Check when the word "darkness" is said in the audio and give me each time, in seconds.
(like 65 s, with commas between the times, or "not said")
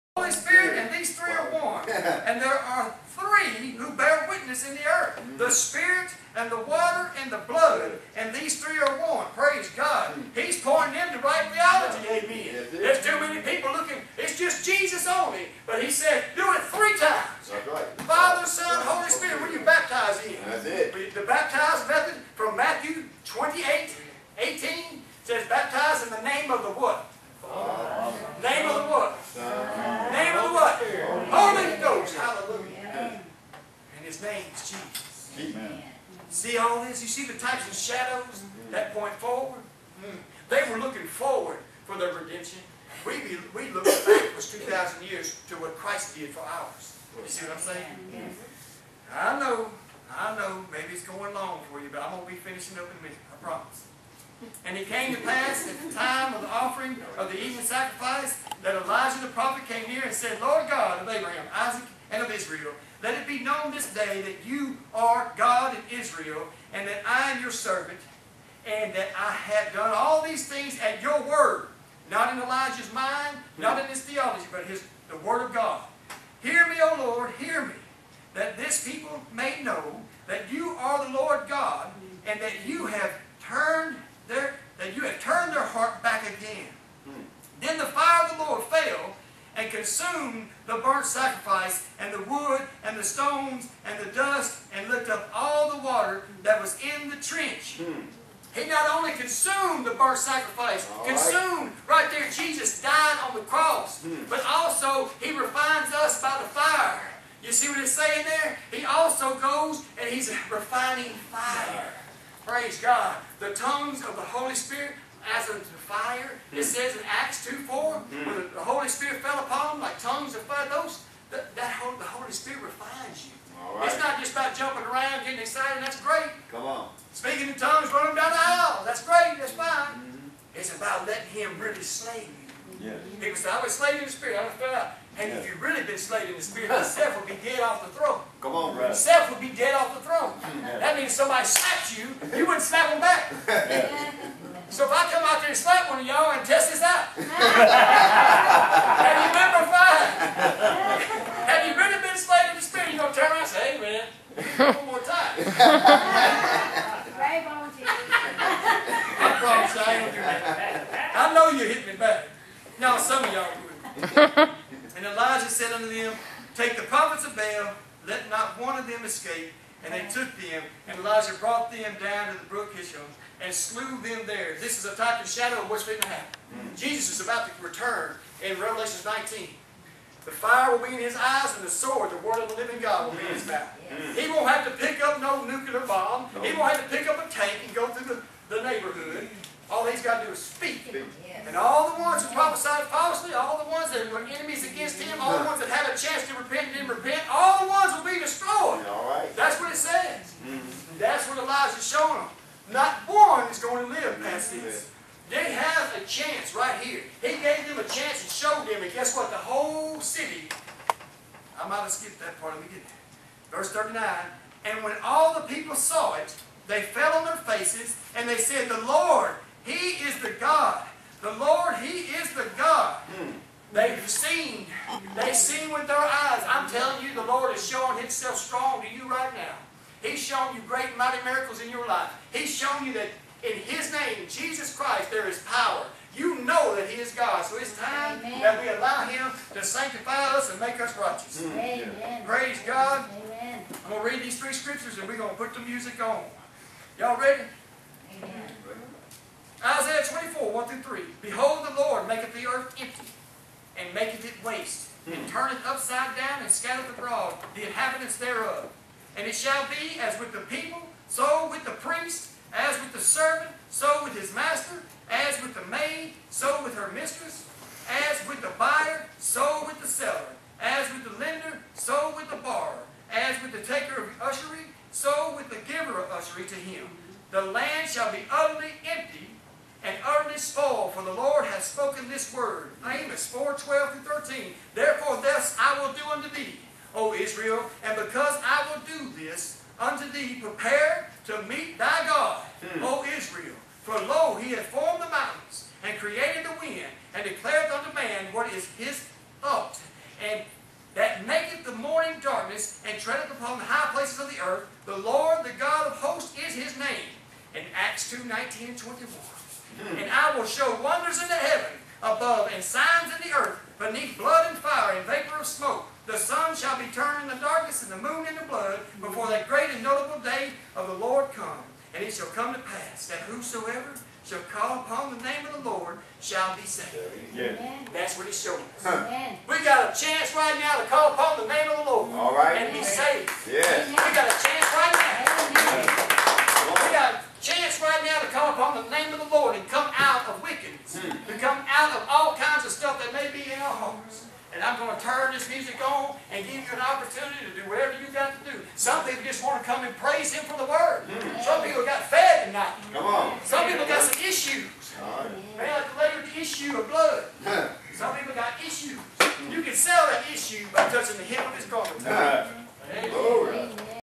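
302 s, 317 s.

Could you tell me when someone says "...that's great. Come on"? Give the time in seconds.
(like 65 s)
125 s.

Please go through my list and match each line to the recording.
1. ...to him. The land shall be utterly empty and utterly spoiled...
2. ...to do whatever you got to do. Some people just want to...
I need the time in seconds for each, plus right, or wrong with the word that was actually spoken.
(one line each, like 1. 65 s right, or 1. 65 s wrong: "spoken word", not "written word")
1. 276 s right
2. 347 s right.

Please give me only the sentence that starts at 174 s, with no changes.
This is a type and shadow of what's going to happen.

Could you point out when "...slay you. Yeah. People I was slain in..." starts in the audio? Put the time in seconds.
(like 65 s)
131 s.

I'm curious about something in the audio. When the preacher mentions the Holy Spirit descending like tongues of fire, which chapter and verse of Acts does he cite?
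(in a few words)
Acts 2:4.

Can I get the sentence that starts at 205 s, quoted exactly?
They have a chance right here.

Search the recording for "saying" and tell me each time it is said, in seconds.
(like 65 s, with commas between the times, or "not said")
47 s, 107 s.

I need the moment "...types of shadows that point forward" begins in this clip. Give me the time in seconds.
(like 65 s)
37 s.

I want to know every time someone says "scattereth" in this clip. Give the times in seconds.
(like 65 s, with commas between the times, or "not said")
256 s.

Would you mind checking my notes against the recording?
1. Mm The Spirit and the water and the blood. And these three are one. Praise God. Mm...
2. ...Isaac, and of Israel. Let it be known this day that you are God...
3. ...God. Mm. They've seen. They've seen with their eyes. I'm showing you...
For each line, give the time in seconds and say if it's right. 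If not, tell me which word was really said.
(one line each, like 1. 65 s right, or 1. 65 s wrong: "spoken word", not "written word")
1. 5 s right
2. 61 s right
3. 222 s wrong: "telling", not "showing".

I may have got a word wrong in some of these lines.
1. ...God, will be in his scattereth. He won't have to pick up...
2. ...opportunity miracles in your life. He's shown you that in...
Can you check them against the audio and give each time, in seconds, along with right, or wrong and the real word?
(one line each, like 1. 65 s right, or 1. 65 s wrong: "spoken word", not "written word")
1. 182 s wrong: "mouth", not "scattereth"
2. 230 s wrong: "mighty", not "opportunity".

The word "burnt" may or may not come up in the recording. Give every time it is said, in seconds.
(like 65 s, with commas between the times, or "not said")
90 s, 99 s.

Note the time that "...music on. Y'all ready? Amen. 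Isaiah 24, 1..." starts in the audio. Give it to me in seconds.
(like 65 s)
245 s.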